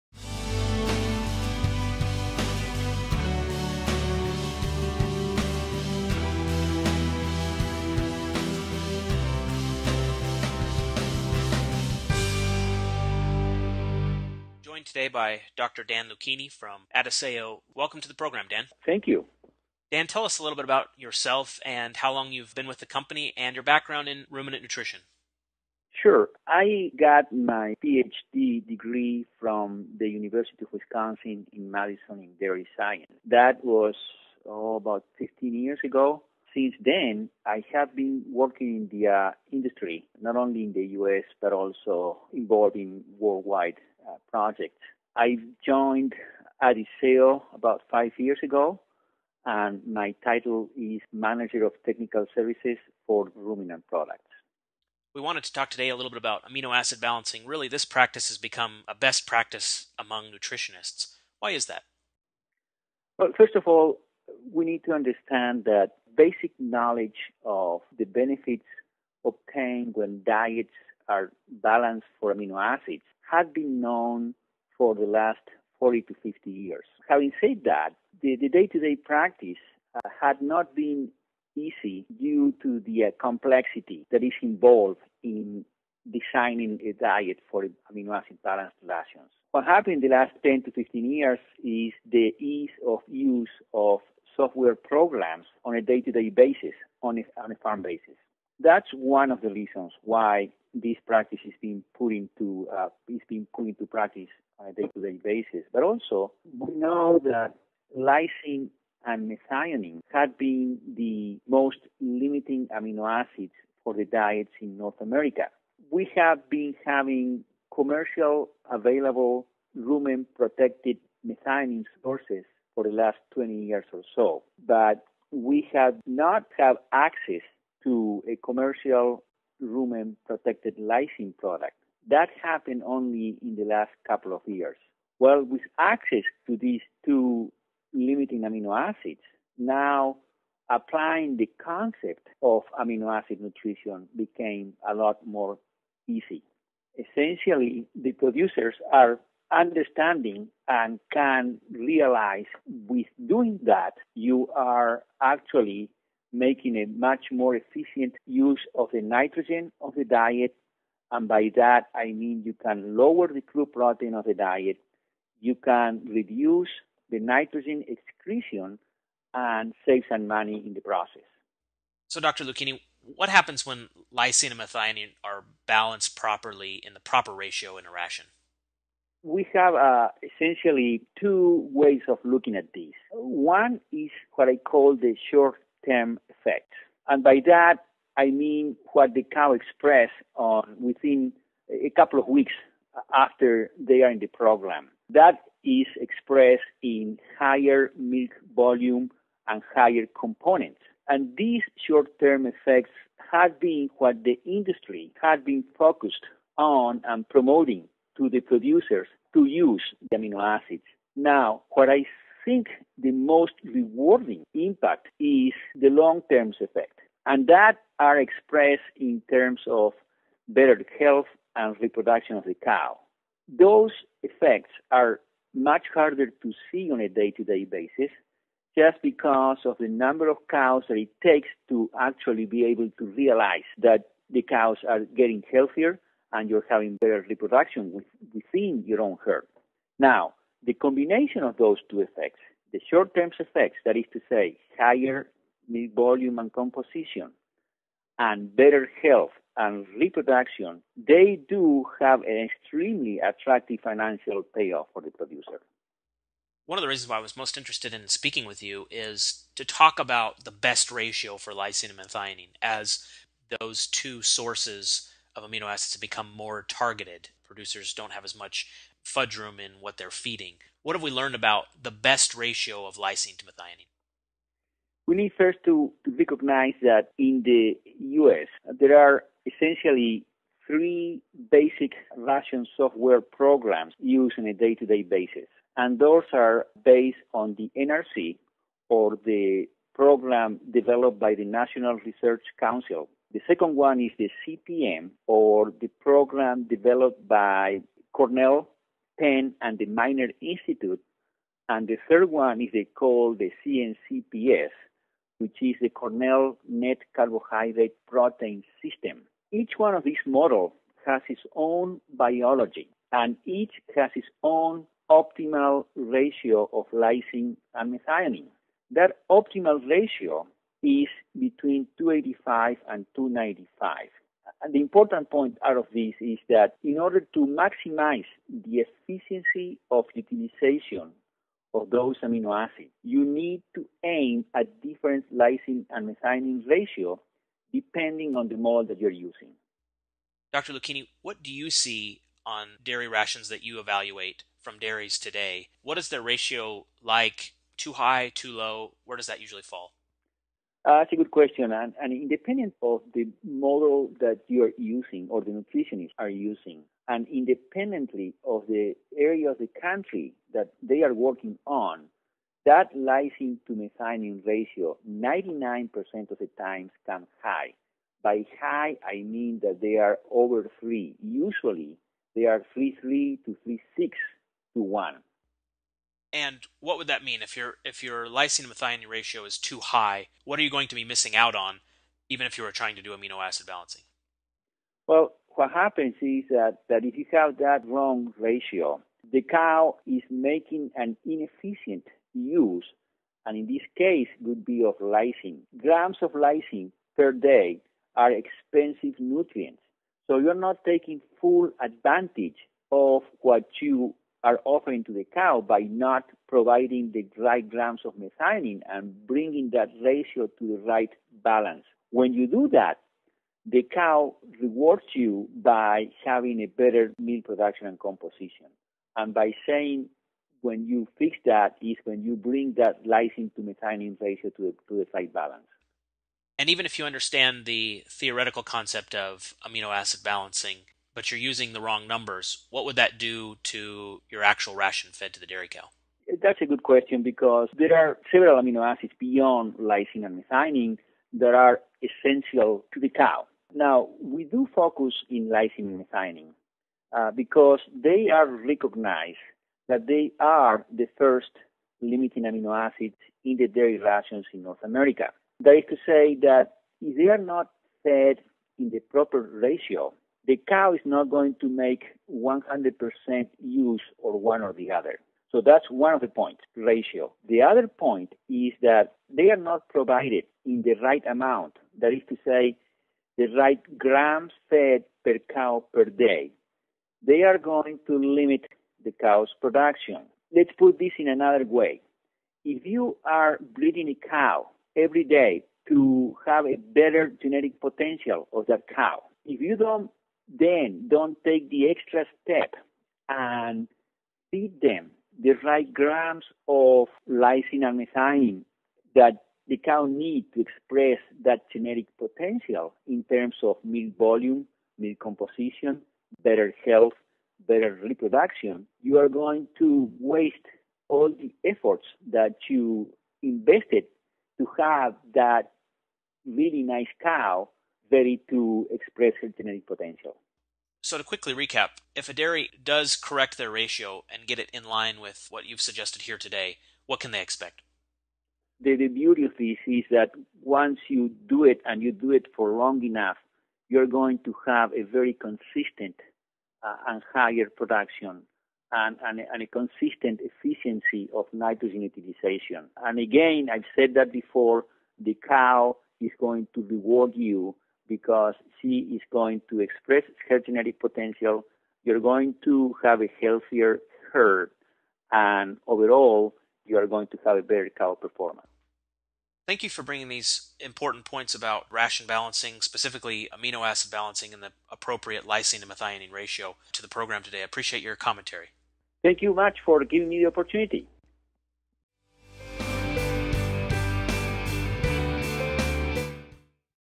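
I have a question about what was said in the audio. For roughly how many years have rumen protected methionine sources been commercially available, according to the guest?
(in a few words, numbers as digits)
20 years.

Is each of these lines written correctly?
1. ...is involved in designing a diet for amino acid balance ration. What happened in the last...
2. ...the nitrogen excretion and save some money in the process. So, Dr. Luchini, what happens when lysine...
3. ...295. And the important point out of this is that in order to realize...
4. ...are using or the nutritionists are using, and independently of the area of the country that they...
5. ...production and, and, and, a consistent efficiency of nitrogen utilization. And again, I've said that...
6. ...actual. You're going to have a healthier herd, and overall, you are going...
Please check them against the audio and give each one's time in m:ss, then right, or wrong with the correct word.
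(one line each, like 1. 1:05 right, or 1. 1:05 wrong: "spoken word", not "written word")
1. 1:24 right
2. 2:47 right
3. 5:23 wrong: "maximize", not "realize"
4. 5:54 right
5. 8:57 right
6. 9:10 wrong: "potential", not "actual".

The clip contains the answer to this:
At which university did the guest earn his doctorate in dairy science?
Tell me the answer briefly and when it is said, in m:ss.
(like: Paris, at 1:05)
University of Wisconsin in Madison, at 0:30.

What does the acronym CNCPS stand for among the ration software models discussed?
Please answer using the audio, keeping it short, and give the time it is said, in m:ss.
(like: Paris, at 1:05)
Cornell Net Carbohydrate Protein System, at 5:05.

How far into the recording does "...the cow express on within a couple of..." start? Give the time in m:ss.
3:09.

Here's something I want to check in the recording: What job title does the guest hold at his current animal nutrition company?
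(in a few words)
Manager of Technical Services.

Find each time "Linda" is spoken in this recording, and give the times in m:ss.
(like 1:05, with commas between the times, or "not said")
not said.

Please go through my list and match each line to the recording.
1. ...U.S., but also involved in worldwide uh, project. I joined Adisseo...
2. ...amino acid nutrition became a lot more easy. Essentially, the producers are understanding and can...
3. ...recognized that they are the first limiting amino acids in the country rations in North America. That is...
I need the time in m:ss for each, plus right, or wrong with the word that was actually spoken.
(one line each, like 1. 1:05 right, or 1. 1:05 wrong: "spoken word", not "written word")
1. 0:40 right
2. 2:22 right
3. 7:28 wrong: "dairy", not "country".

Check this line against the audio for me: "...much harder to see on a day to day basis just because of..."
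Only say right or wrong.
right.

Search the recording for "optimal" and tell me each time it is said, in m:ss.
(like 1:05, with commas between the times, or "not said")
5:15, 5:19.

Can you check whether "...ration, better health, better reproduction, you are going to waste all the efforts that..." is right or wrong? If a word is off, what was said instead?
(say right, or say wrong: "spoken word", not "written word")
wrong: "composition", not "ration".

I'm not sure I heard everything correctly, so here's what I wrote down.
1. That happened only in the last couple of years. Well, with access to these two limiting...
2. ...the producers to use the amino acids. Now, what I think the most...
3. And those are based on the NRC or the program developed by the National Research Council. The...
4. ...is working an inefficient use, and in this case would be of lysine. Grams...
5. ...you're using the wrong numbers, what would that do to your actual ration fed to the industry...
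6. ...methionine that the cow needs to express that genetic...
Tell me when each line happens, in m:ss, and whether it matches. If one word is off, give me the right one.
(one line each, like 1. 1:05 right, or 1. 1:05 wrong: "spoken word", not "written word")
1. 2:12 right
2. 3:28 right
3. 4:45 right
4. 6:30 wrong: "making", not "working"
5. 7:11 wrong: "dairy", not "industry"
6. 8:17 right.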